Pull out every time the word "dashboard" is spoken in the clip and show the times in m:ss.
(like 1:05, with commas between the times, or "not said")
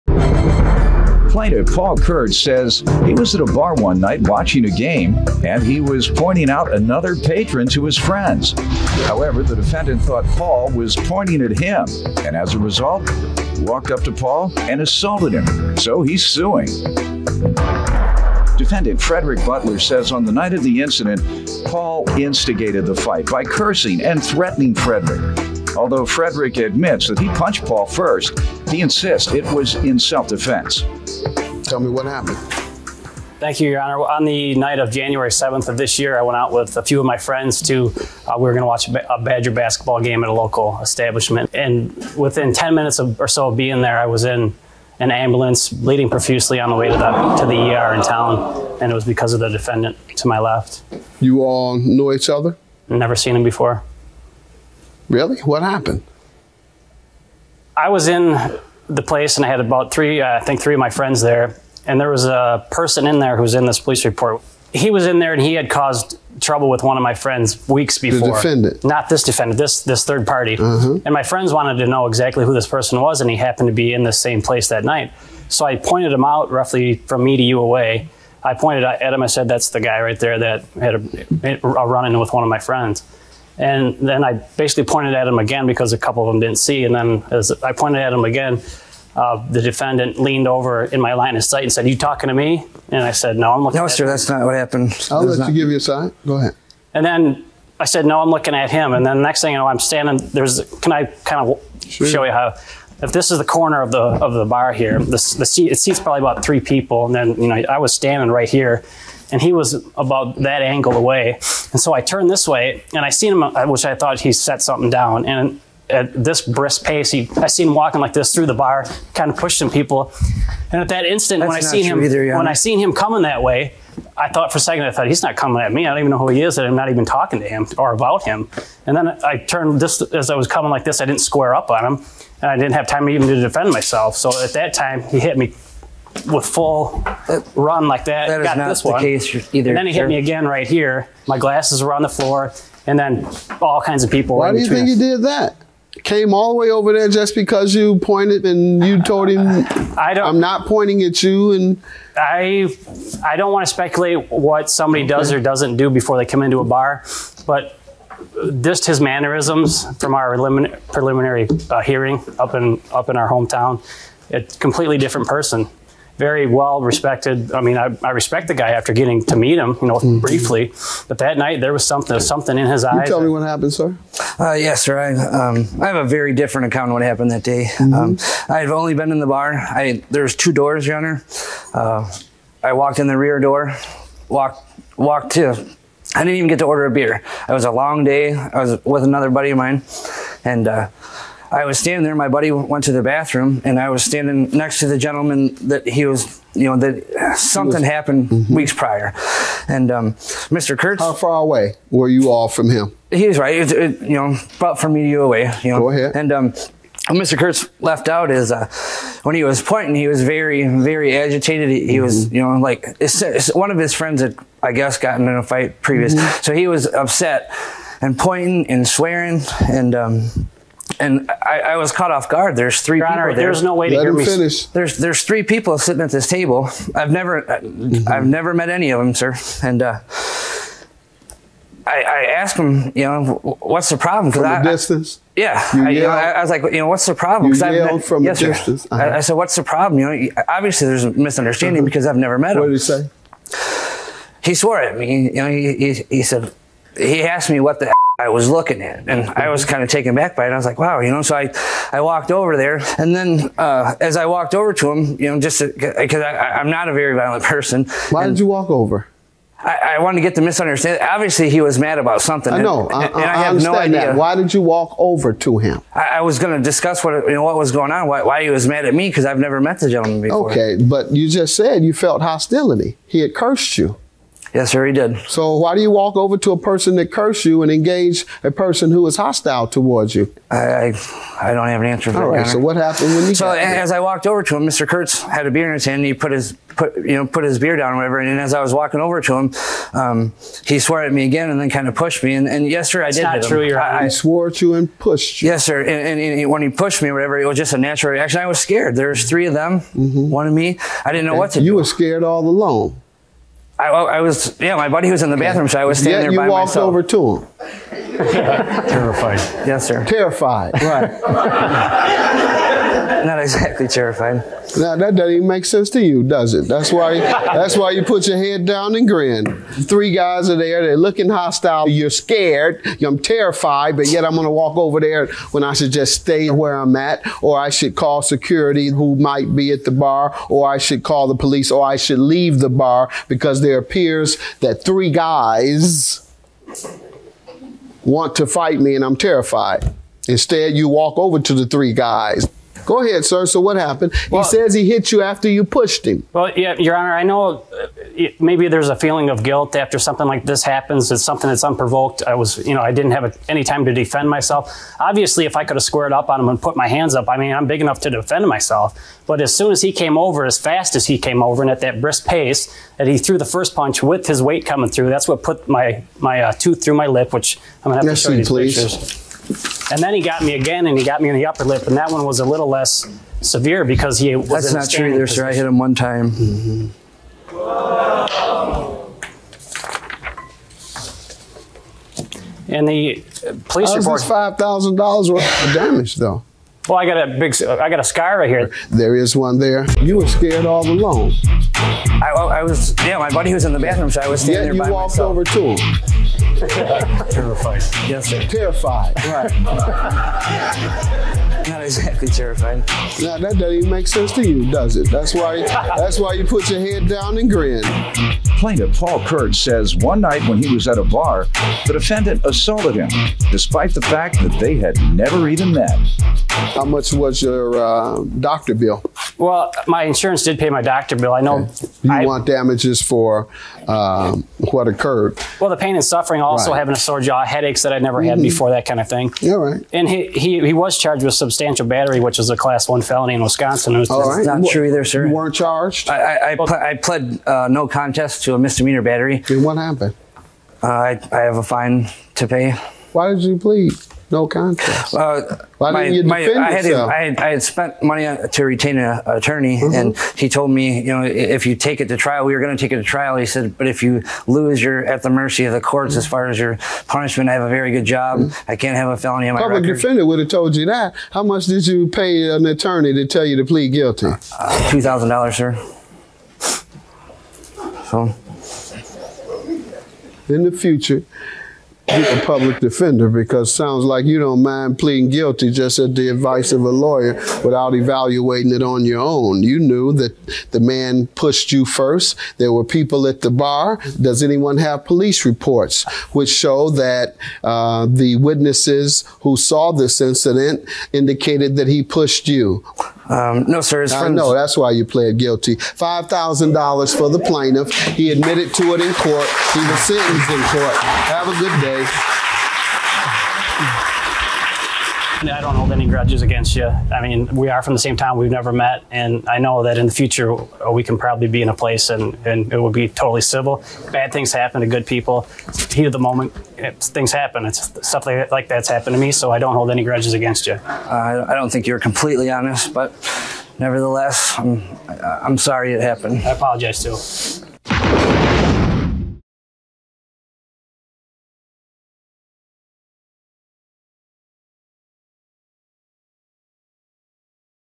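not said.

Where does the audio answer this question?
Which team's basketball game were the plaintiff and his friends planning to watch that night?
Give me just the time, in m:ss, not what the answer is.
0:39.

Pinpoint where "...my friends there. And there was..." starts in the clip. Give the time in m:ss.
1:00.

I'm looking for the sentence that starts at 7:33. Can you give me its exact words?
He said, but if you lose, you're at the mercy of the courts mm -hmm.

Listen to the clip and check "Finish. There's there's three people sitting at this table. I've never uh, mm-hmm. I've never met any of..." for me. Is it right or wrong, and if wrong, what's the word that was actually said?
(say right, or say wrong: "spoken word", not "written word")
right.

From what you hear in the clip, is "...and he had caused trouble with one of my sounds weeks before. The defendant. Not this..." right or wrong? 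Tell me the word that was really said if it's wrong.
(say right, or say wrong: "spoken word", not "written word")
wrong: "friends", not "sounds".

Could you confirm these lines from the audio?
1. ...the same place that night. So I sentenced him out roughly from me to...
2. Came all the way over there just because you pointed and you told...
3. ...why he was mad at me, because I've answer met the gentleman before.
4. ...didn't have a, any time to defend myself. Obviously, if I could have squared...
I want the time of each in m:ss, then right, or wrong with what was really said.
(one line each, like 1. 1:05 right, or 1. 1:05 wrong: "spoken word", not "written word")
1. 1:14 wrong: "pointed", not "sentenced"
2. 2:26 right
3. 4:28 wrong: "never", not "answer"
4. 5:52 right.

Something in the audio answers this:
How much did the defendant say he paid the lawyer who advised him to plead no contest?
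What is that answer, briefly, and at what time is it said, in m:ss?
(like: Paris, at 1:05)
$2,000, at 7:44.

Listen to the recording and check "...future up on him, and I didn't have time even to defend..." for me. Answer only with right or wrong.
wrong.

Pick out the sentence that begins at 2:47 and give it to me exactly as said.
I mean, I, I, respect the guy after getting to meet him, you know, mm-hmm.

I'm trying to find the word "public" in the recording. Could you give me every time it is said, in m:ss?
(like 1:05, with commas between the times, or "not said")
7:39, 7:52.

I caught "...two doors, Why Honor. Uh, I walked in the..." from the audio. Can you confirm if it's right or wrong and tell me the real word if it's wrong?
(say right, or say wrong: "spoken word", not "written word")
wrong: "Your", not "Why".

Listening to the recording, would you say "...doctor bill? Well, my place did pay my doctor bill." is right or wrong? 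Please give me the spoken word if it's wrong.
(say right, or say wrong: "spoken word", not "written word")
wrong: "insurance", not "place".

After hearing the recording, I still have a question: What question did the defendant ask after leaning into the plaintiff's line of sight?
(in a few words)
You talking to me?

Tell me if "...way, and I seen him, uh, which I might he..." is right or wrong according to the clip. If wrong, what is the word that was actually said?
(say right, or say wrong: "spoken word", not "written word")
wrong: "thought", not "might".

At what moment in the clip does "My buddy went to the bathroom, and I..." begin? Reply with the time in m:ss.
3:12.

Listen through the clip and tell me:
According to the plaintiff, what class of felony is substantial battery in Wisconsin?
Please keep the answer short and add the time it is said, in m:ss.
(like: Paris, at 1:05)
class one, at 7:12.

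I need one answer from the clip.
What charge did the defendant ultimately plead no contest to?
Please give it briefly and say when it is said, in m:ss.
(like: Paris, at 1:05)
misdemeanor battery, at 7:18.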